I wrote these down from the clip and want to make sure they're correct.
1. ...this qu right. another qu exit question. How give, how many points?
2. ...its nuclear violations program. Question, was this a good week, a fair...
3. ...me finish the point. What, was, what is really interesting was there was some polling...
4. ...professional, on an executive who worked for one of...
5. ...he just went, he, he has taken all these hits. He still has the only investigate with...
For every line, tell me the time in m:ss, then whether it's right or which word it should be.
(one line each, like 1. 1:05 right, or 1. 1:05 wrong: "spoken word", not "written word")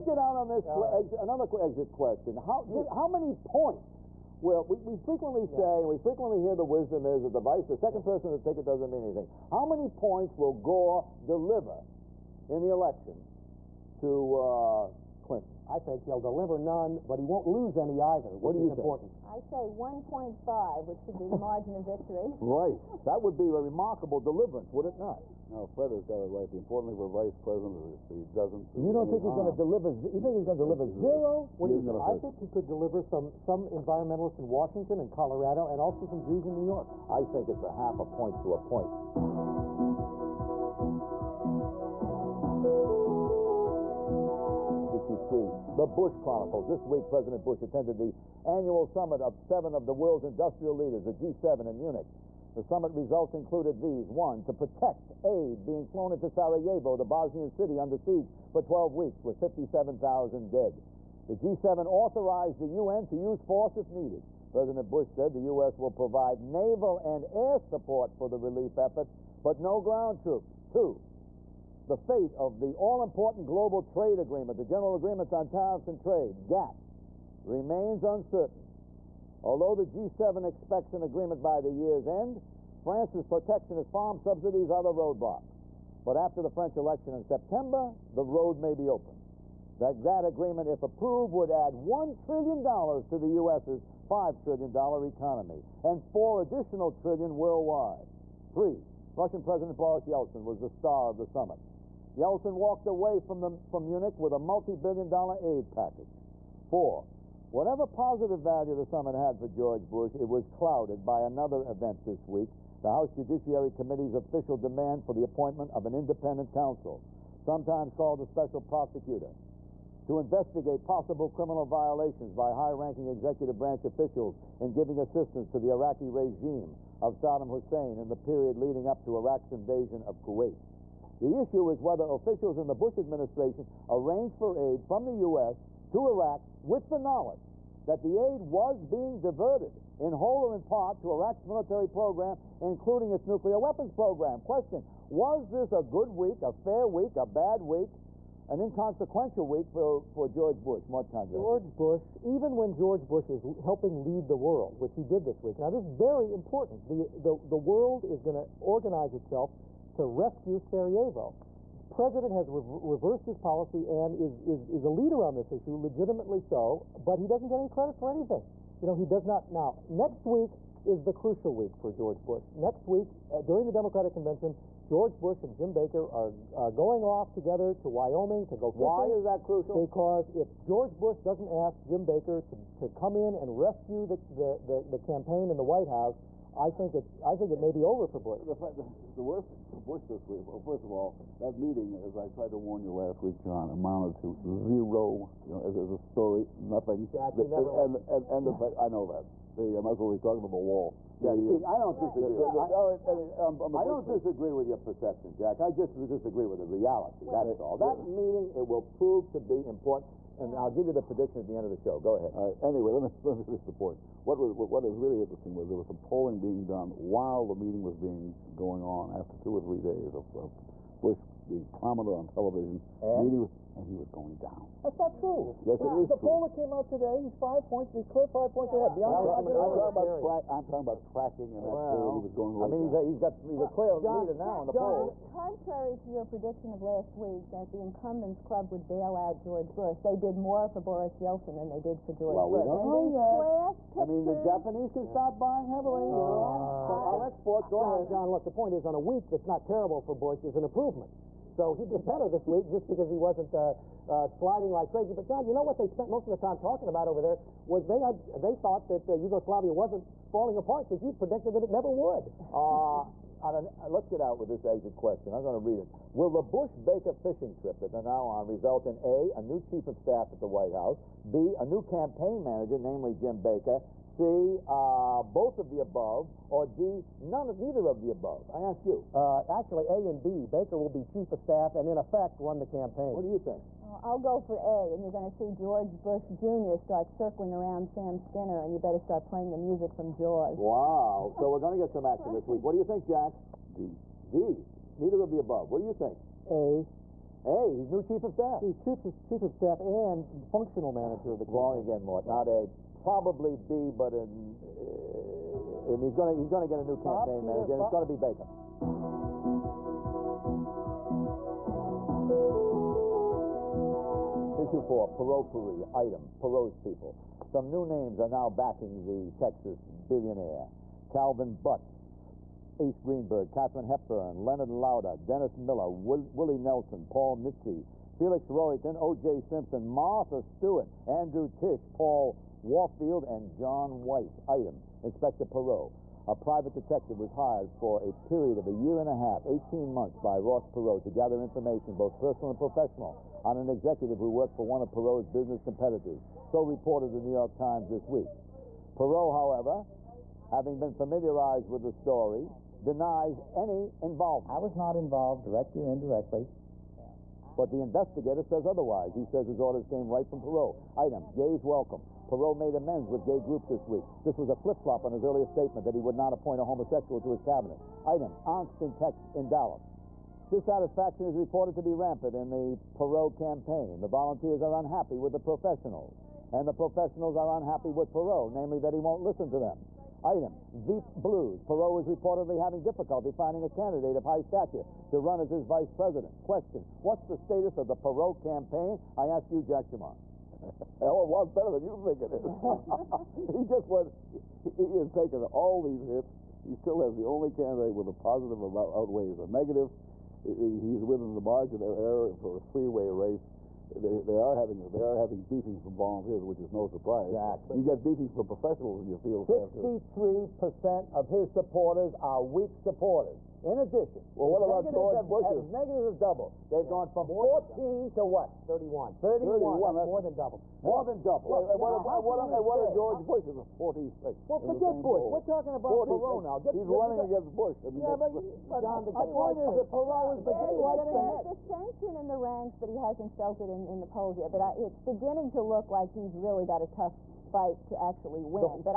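1. 0:00 right
2. 2:23 wrong: "weapons", not "violations"
3. 3:33 right
4. 5:42 right
5. 6:33 wrong: "candidate", not "investigate".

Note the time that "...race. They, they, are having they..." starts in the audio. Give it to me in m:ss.
6:43.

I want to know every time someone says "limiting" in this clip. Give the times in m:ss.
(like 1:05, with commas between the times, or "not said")
not said.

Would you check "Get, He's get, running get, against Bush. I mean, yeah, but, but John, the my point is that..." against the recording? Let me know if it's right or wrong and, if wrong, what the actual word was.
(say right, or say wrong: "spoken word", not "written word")
right.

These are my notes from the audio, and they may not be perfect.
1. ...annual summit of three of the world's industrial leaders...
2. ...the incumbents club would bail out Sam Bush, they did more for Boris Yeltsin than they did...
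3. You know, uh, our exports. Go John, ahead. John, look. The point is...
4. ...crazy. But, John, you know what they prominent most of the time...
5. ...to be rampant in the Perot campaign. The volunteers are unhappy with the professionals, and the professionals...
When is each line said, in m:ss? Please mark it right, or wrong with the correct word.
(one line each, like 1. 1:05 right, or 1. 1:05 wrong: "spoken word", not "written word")
1. 0:48 wrong: "seven", not "three"
2. 3:57 wrong: "George", not "Sam"
3. 4:06 right
4. 4:14 wrong: "spent", not "prominent"
5. 6:11 right.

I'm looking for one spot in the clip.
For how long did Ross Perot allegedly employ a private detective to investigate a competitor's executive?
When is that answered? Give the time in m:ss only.
5:39.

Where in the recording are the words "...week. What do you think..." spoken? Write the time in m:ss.
4:52.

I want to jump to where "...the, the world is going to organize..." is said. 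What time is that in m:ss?
2:37.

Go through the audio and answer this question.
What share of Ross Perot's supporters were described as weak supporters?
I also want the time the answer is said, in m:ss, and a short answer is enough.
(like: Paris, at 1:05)
63 percent, at 6:49.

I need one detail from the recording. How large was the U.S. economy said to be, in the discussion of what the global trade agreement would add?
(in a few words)
$5 trillion.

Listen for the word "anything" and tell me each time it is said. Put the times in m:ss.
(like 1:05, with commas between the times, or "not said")
0:09, 2:48.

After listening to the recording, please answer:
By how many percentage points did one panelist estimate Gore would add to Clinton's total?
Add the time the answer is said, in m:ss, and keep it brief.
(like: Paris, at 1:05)
1.5, at 0:19.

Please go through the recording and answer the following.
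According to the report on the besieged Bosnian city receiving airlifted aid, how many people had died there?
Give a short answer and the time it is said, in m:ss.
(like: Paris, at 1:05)
57,000, at 0:59.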